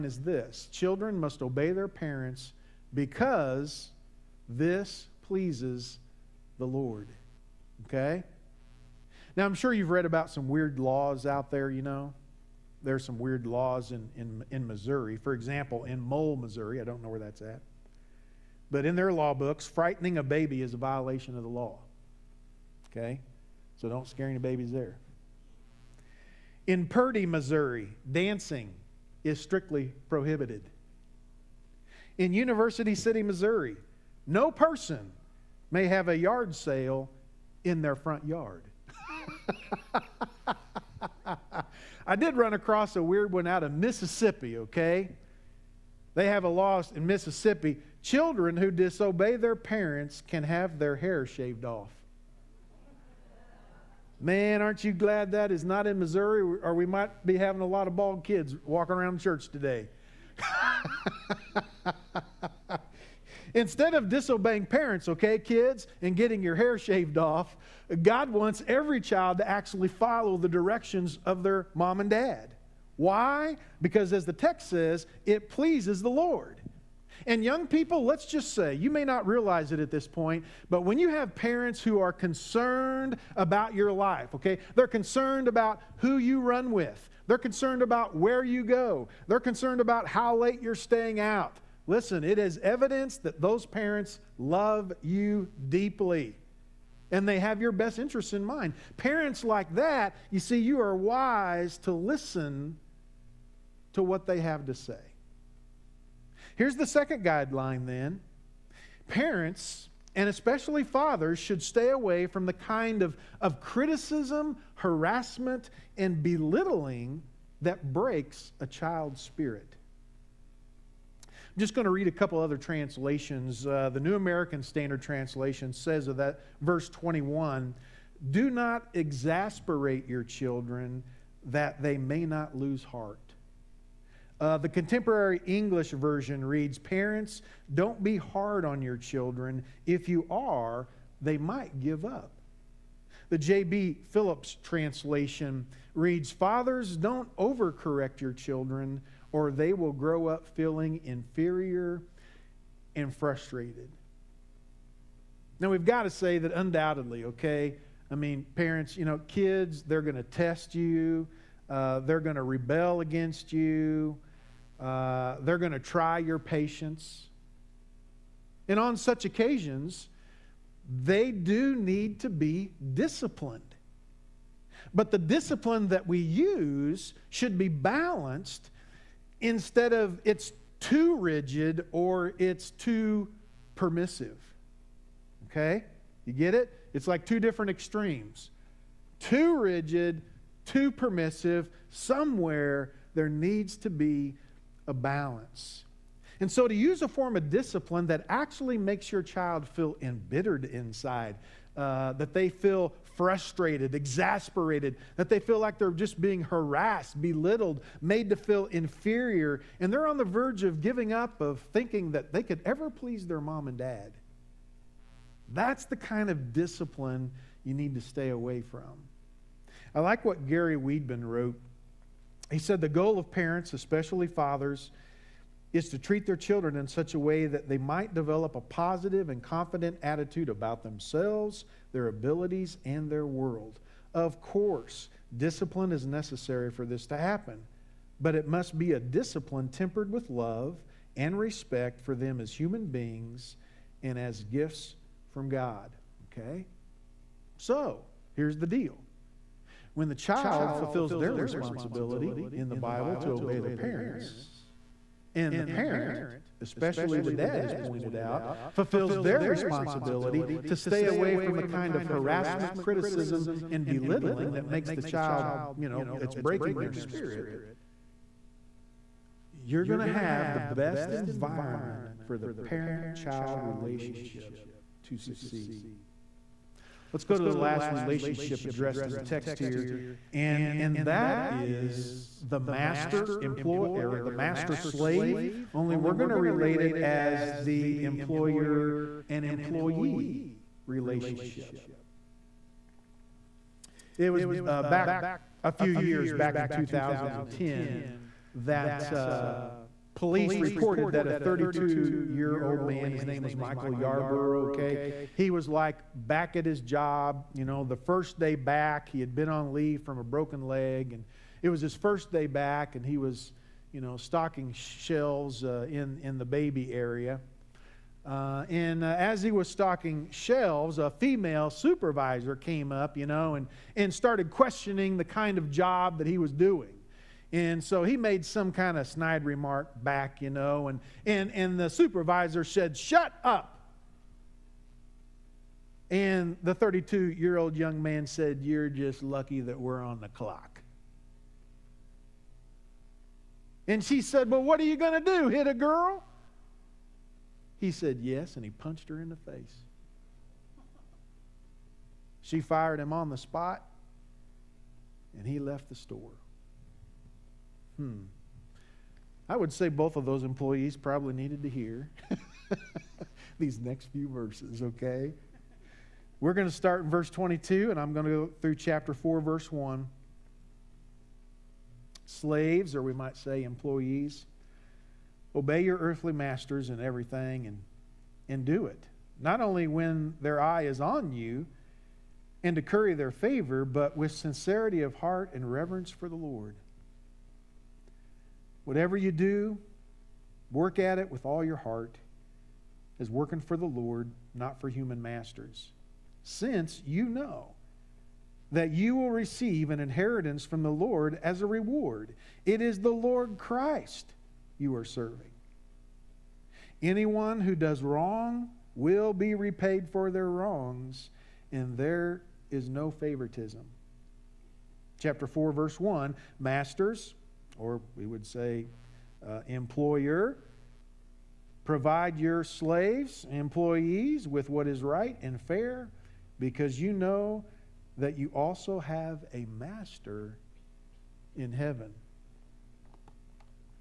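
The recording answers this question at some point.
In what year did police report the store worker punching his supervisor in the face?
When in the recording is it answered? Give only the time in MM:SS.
04:56.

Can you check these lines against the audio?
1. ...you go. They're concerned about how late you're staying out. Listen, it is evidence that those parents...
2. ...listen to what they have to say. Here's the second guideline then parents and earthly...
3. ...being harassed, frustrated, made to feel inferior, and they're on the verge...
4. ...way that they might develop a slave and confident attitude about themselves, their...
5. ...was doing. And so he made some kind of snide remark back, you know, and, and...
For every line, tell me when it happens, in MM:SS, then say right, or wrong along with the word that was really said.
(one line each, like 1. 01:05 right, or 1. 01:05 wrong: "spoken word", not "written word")
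1. 01:28 right
2. 01:41 wrong: "especially", not "earthly"
3. 03:26 wrong: "belittled", not "frustrated"
4. 03:47 wrong: "positive", not "slave"
5. 05:26 right.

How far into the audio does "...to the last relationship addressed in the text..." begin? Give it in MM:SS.
04:37.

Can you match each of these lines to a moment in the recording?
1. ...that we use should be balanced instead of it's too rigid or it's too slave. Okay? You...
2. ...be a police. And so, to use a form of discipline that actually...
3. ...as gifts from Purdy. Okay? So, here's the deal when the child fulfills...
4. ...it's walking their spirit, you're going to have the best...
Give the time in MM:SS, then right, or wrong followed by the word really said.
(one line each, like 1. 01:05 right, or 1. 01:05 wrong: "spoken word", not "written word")
1. 02:55 wrong: "permissive", not "slave"
2. 03:13 wrong: "balance", not "police"
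3. 04:04 wrong: "God", not "Purdy"
4. 04:26 wrong: "breaking", not "walking".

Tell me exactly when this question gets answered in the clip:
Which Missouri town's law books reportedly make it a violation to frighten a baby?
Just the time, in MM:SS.
00:15.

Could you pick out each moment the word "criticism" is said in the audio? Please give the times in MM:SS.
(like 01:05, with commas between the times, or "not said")
01:53, 04:22.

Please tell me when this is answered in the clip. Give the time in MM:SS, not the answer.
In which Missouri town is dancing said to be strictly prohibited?
00:26.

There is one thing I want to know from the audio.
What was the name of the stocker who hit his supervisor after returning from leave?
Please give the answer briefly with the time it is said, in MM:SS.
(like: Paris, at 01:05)
Michael Yarborough, at 05:03.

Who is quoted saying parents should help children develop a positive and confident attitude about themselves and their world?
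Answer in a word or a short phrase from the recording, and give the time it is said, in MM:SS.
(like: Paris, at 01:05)
Gary Weedman, at 03:40.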